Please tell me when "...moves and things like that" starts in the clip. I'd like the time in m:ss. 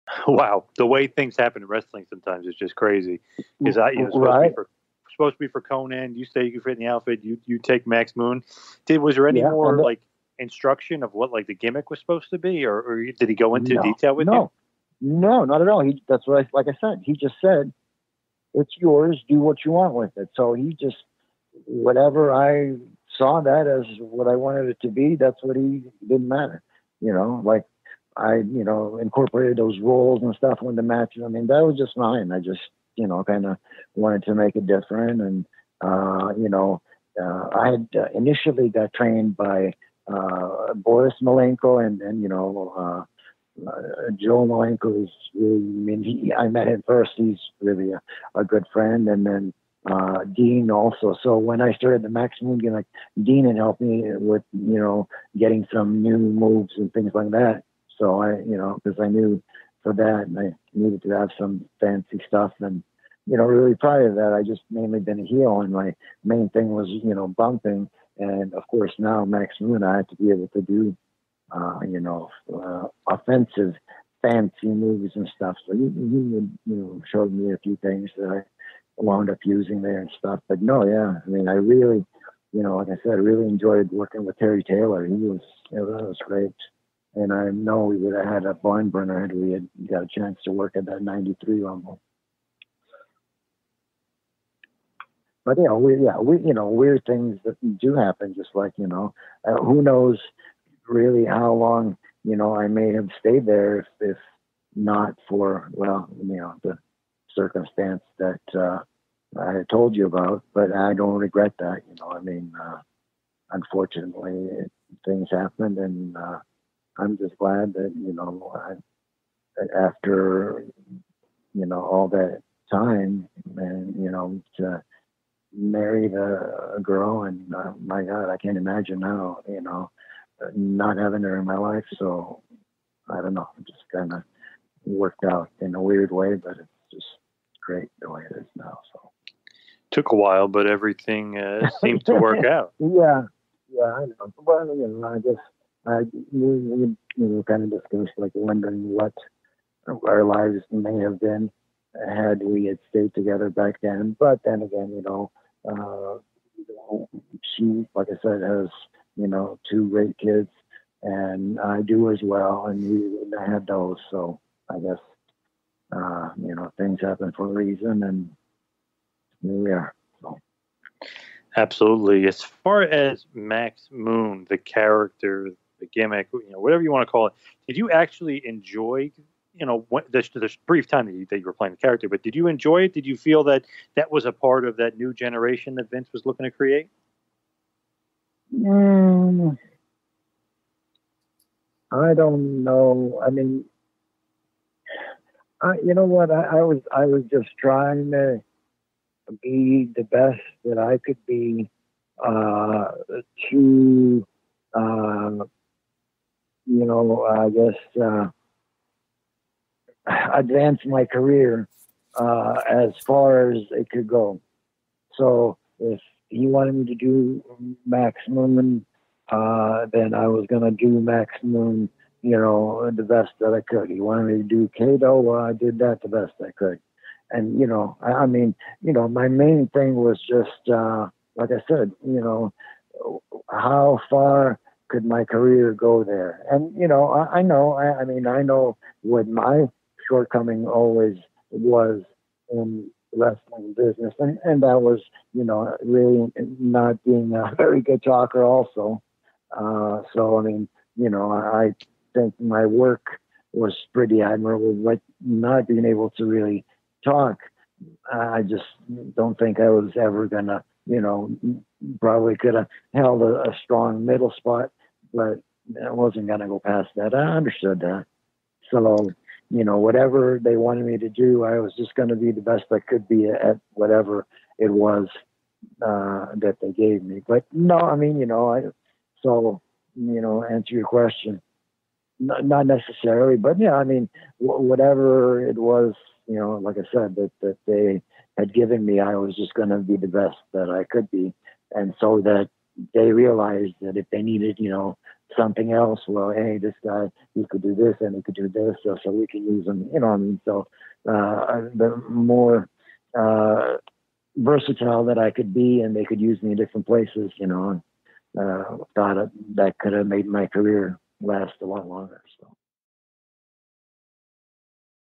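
0:56.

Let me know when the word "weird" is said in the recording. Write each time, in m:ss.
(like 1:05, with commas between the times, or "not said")
1:36, 2:15.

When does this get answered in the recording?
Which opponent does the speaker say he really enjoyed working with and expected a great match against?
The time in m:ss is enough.
1:24.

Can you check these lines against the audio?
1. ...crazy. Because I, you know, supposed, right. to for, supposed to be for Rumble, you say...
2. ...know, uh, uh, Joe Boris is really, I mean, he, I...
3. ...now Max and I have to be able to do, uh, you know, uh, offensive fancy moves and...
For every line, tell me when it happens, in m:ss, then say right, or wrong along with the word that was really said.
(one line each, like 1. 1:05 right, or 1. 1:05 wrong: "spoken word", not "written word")
1. 0:02 wrong: "Konnan", not "Rumble"
2. 0:42 wrong: "Malenko", not "Boris"
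3. 1:08 right.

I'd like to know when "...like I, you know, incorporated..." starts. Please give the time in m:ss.
0:27.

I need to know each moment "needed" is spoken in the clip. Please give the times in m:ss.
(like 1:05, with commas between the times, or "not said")
1:00, 4:54.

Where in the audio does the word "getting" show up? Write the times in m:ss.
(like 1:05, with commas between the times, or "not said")
0:55.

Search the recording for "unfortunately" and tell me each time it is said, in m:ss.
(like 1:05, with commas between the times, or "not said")
1:53.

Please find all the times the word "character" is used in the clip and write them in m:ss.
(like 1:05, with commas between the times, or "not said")
2:54, 3:01.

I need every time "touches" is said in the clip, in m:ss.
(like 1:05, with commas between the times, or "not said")
not said.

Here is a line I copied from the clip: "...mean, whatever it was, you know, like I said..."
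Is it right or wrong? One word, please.
right.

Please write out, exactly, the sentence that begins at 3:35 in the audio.
So if he wanted me to do Max Moon, uh, then I was going to do Max Moon.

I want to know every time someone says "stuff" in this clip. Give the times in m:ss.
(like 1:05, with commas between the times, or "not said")
0:30, 1:02, 1:15, 1:20.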